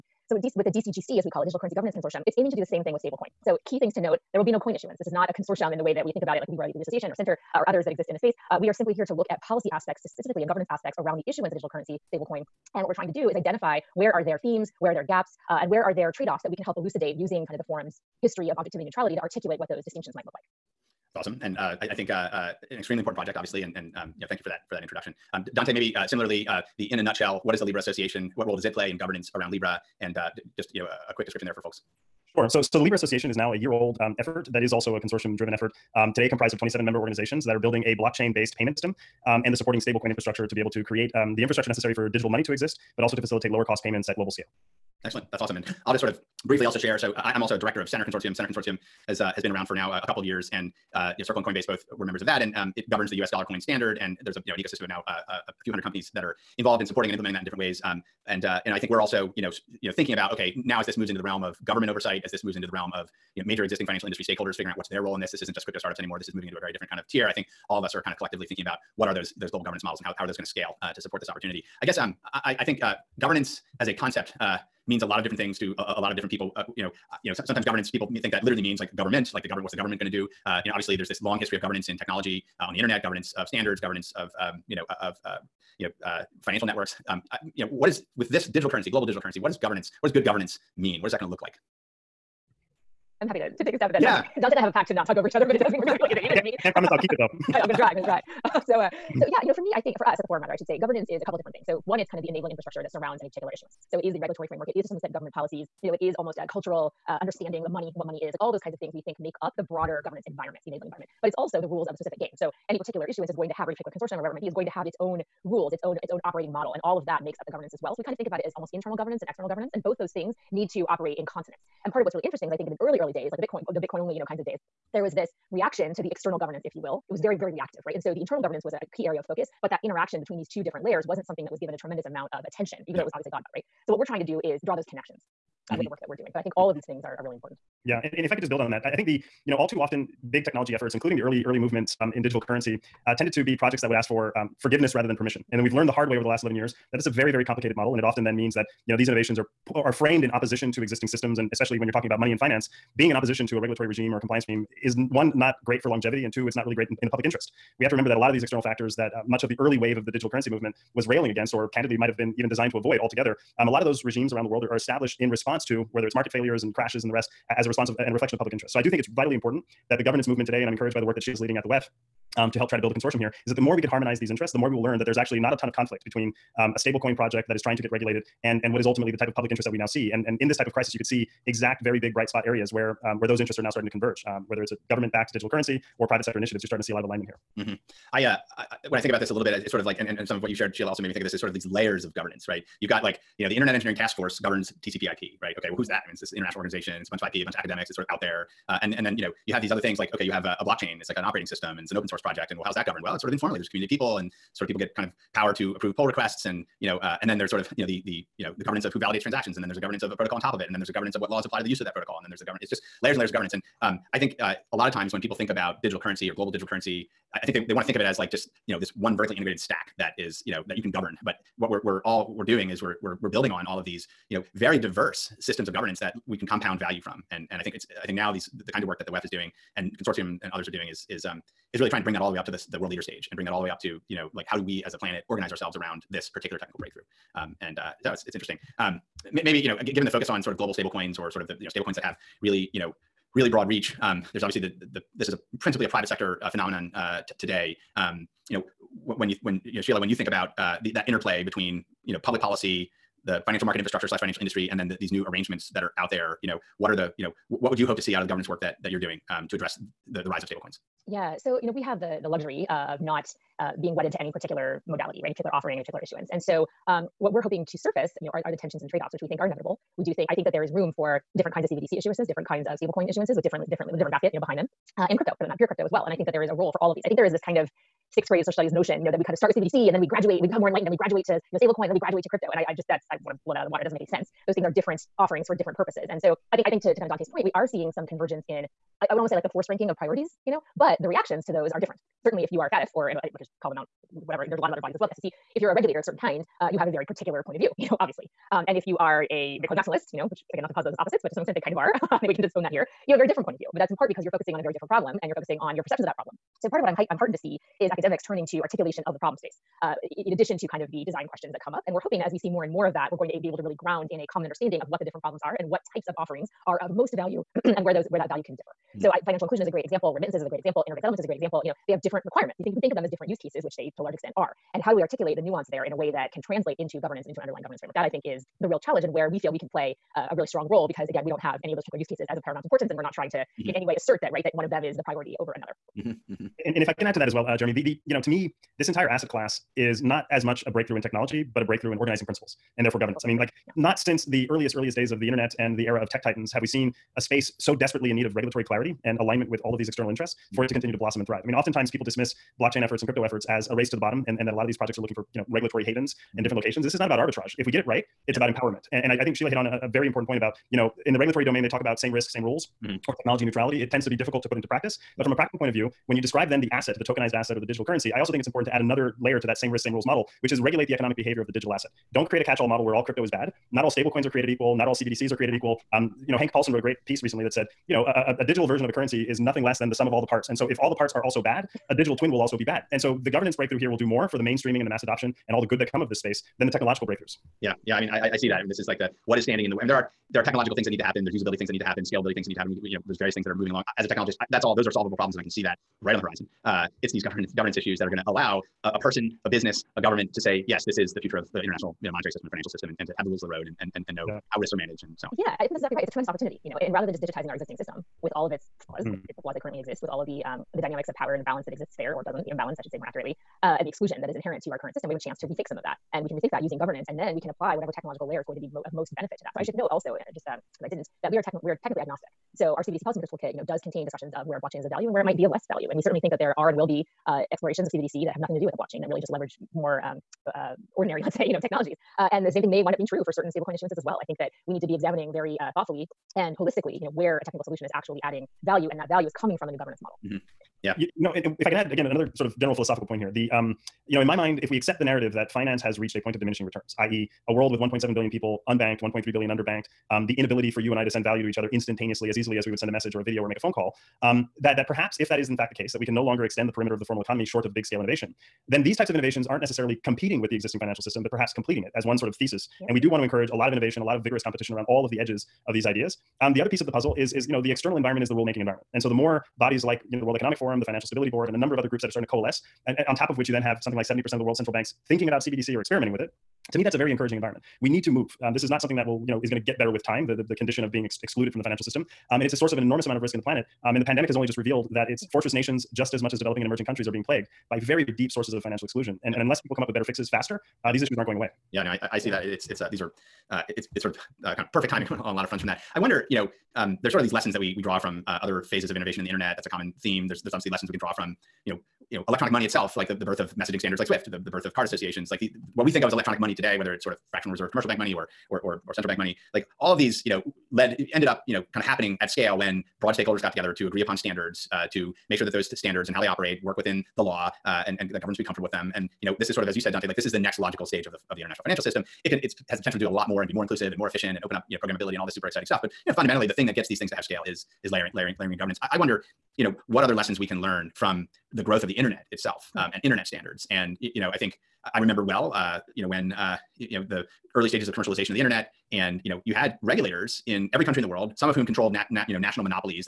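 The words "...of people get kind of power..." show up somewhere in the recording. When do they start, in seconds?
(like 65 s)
204 s.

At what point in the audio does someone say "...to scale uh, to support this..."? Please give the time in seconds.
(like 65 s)
70 s.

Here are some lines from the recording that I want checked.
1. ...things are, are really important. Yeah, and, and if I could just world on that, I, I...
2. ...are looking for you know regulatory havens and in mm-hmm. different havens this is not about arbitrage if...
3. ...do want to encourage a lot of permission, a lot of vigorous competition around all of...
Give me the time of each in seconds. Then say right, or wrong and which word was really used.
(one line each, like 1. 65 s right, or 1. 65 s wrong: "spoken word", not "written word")
1. 136 s wrong: "build", not "world"
2. 354 s wrong: "locations", not "havens"
3. 462 s wrong: "innovation", not "permission".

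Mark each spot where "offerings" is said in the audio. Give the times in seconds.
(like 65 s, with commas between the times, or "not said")
265 s, 285 s, 316 s.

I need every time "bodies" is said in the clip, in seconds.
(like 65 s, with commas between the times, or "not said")
294 s, 469 s.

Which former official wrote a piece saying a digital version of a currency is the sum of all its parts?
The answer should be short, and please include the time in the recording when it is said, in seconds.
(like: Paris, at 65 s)
Hank Paulson, at 376 s.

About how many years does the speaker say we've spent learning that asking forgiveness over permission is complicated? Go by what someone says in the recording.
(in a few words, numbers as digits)
11.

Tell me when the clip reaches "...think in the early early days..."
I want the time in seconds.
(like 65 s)
122 s.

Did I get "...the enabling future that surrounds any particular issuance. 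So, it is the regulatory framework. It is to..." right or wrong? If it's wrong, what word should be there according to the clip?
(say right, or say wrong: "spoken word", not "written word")
wrong: "infrastructure", not "future".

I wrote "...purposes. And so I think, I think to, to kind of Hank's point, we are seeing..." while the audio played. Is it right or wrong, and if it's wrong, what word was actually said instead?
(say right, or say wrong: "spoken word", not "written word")
wrong: "Dante", not "Hank".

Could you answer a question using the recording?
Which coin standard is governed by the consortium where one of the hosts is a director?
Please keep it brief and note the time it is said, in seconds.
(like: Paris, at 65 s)
U.S. dollar coin, at 53 s.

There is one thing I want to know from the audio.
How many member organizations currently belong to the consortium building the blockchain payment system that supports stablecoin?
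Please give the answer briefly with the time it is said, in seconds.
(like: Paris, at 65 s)
27, at 36 s.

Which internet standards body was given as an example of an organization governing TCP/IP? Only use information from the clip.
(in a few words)
Internet Engineering Task Force.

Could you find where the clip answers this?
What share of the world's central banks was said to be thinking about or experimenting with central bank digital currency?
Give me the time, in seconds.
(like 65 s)
474 s.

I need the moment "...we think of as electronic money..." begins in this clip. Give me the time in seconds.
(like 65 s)
505 s.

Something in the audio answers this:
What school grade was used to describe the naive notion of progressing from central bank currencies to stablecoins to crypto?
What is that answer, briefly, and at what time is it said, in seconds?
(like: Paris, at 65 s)
sixth grade, at 278 s.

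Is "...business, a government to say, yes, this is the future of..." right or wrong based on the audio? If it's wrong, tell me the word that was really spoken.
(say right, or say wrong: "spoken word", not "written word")
right.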